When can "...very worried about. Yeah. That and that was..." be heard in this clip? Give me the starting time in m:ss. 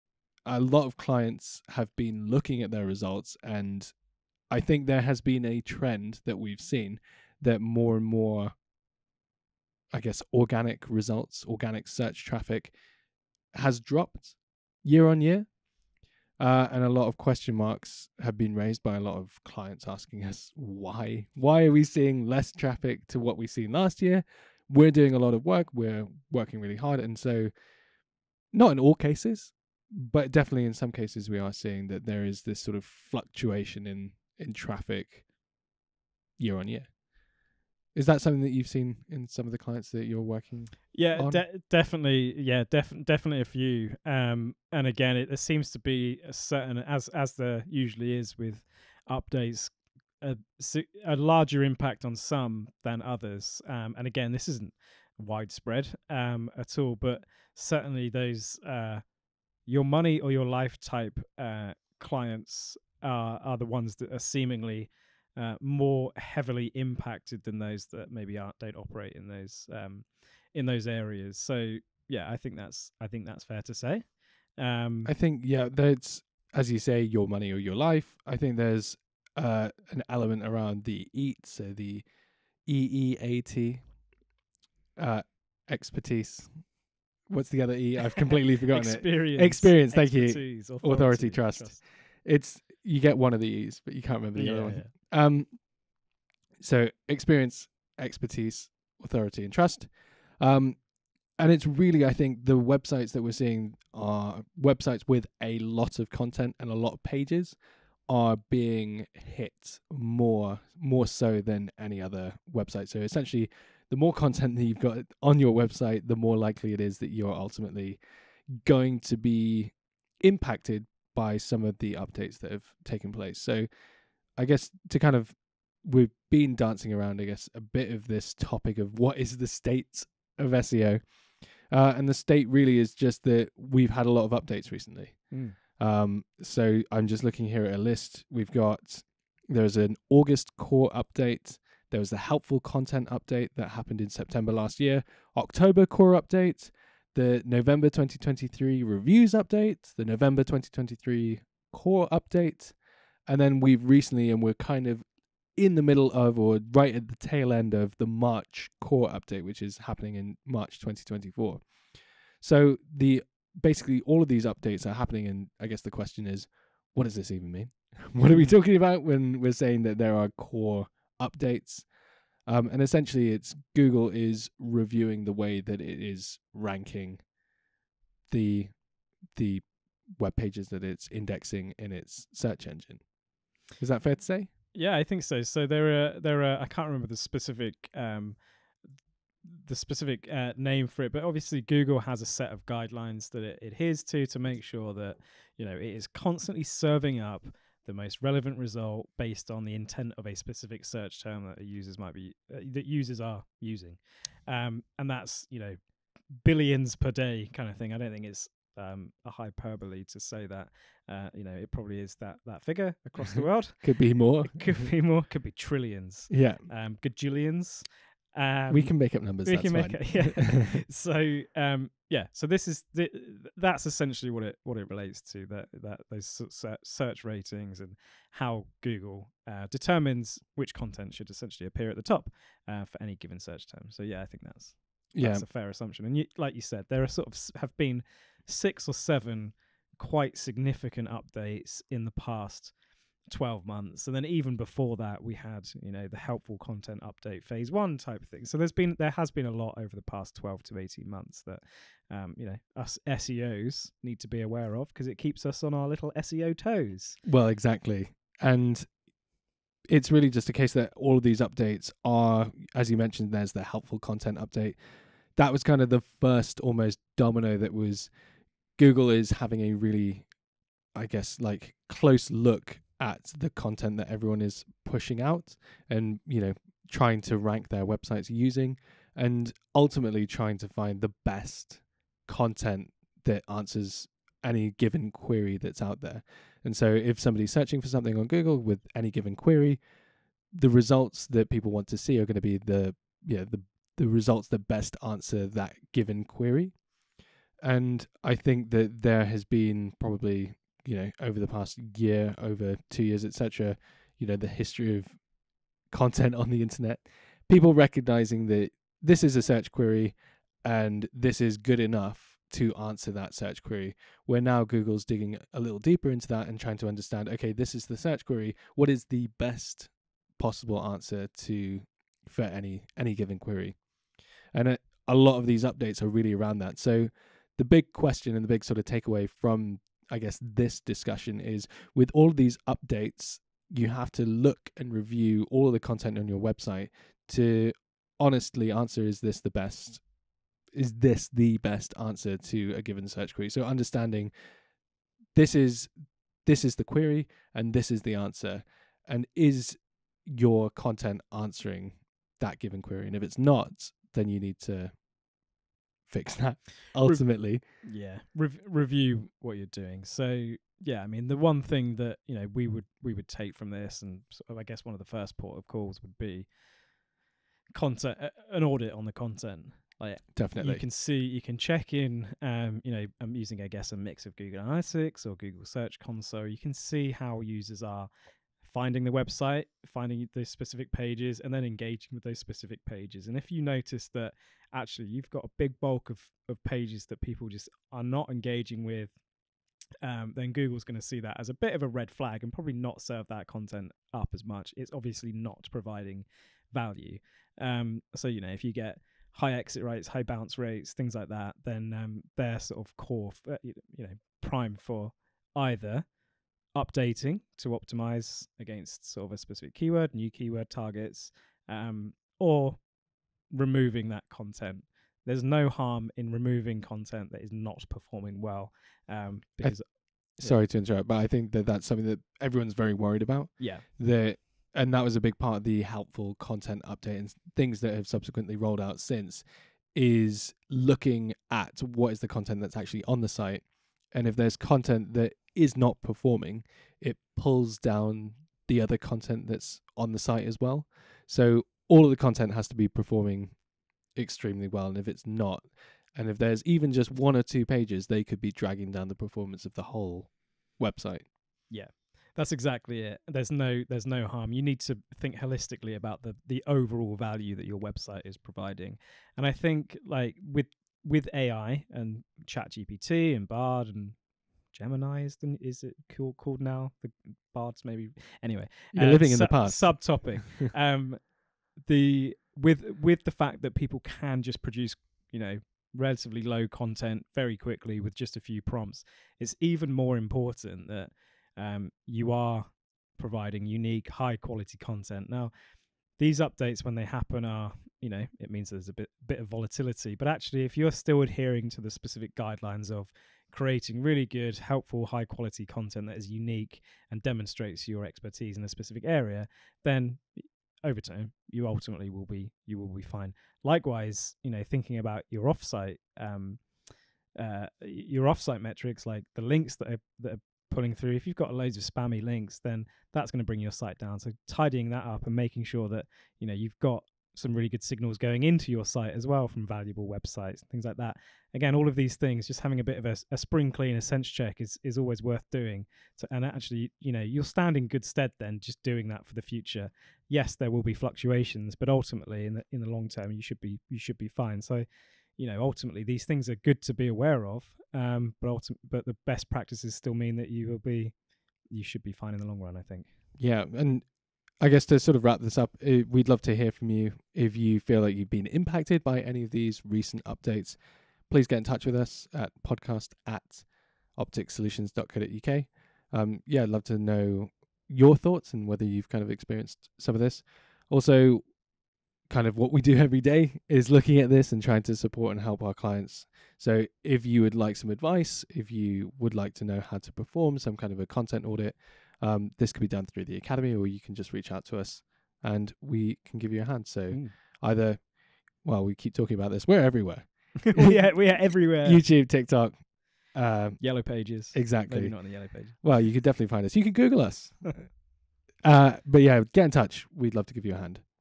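7:02.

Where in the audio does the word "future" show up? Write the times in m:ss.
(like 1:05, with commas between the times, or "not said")
8:49.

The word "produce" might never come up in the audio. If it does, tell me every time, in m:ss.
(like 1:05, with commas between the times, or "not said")
7:54.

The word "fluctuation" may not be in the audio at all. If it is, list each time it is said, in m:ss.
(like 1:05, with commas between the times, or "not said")
0:32, 8:50.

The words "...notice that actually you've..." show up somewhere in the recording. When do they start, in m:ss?
6:23.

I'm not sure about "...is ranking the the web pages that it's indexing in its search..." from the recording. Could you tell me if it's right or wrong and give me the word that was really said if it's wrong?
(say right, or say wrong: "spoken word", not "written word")
right.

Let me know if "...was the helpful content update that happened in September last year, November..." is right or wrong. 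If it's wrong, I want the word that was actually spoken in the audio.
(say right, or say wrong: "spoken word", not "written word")
wrong: "October", not "November".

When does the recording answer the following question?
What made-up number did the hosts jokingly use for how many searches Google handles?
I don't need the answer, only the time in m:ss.
3:37.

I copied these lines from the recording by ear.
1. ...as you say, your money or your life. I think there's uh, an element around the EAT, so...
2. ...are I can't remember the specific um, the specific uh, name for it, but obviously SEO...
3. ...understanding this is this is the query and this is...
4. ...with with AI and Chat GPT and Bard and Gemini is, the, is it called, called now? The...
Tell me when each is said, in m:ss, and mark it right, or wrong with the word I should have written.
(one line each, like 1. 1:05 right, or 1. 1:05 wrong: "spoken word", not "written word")
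1. 1:16 right
2. 3:06 wrong: "Google", not "SEO"
3. 5:43 right
4. 7:40 right.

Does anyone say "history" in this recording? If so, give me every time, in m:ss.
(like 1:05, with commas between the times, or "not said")
5:04.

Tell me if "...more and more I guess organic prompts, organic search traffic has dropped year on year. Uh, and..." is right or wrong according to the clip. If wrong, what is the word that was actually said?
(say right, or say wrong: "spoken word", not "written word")
wrong: "results", not "prompts".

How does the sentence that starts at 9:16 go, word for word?
Um, yeah, I'd love to know your thoughts and whether you've kind of experienced some of this.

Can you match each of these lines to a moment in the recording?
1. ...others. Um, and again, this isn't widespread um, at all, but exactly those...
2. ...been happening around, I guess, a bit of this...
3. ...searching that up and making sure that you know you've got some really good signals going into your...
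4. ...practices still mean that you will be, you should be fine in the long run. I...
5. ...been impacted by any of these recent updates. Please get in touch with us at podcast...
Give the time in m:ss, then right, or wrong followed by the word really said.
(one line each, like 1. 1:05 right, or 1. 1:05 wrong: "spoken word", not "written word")
1. 0:53 wrong: "certainly", not "exactly"
2. 2:06 wrong: "dancing", not "happening"
3. 8:34 wrong: "tidying", not "searching"
4. 8:59 right
5. 9:08 right.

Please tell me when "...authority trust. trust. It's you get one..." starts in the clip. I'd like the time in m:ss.
1:30.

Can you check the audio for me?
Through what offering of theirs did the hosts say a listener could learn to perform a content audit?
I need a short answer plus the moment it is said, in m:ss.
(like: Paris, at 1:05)
The academy, at 9:33.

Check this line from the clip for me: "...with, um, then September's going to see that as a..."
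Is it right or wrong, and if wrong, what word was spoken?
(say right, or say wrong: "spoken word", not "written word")
wrong: "Google", not "September".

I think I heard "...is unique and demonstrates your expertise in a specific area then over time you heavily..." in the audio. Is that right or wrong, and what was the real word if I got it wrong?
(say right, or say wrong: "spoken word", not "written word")
wrong: "ultimately", not "heavily".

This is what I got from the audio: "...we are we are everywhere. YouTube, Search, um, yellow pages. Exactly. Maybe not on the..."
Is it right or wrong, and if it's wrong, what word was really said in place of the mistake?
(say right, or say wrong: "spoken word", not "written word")
wrong: "TikTok", not "Search".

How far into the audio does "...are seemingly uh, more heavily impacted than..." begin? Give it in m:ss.
1:04.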